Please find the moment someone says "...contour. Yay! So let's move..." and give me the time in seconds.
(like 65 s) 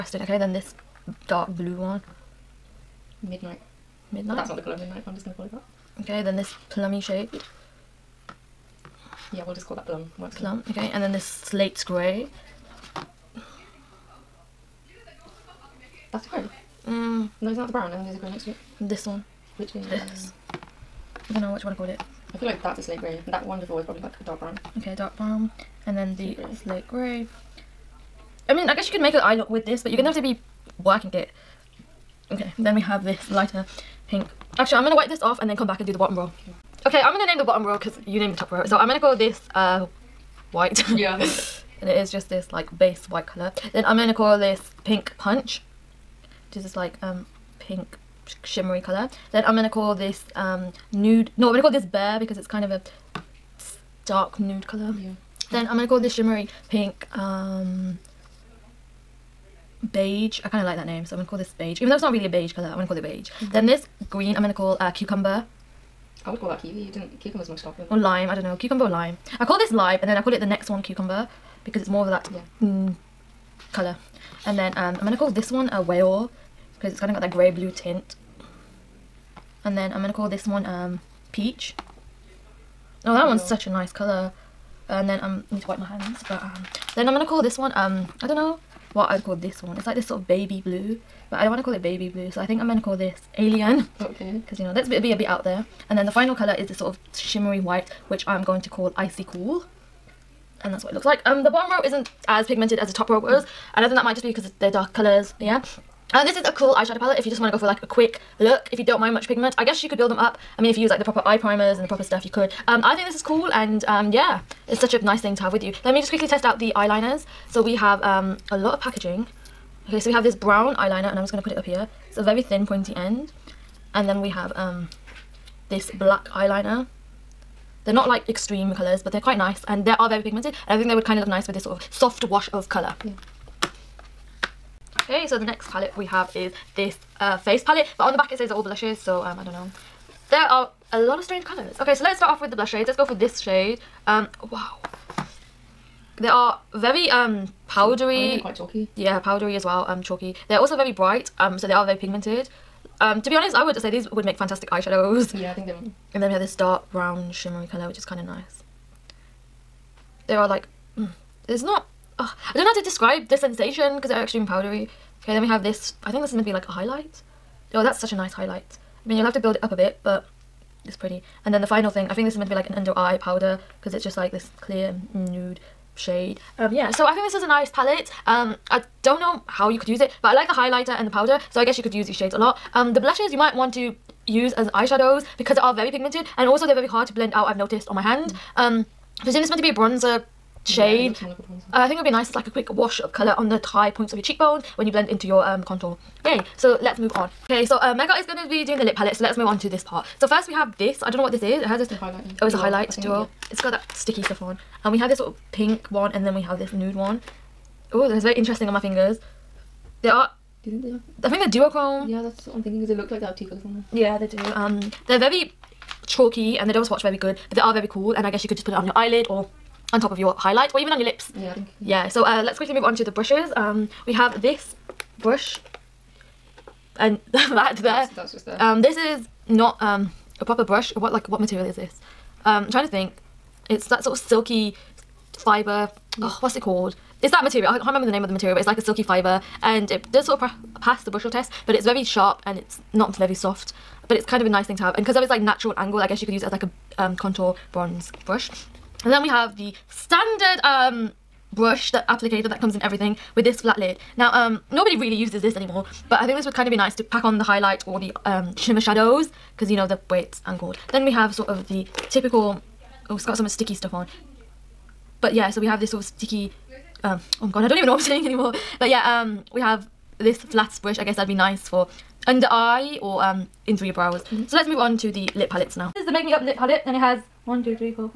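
195 s.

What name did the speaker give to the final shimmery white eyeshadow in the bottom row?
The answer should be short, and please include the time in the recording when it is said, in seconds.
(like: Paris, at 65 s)
Icy cool, at 98 s.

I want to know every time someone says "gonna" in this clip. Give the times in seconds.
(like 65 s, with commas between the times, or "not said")
5 s, 29 s, 75 s, 80 s, 87 s, 92 s.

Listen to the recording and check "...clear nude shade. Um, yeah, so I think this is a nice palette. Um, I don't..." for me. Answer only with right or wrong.
right.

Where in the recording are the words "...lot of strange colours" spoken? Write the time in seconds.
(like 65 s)
140 s.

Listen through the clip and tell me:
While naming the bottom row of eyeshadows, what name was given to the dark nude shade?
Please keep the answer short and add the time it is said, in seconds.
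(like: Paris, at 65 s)
Bear, at 51 s.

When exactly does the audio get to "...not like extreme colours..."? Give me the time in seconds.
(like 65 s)
127 s.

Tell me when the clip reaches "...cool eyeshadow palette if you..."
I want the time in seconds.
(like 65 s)
106 s.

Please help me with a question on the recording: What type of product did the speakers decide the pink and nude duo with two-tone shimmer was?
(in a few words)
Duochrome.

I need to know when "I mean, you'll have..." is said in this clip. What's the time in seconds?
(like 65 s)
169 s.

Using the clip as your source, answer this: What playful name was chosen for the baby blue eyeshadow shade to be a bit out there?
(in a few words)
Alien.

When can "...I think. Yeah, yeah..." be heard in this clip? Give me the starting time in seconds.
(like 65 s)
221 s.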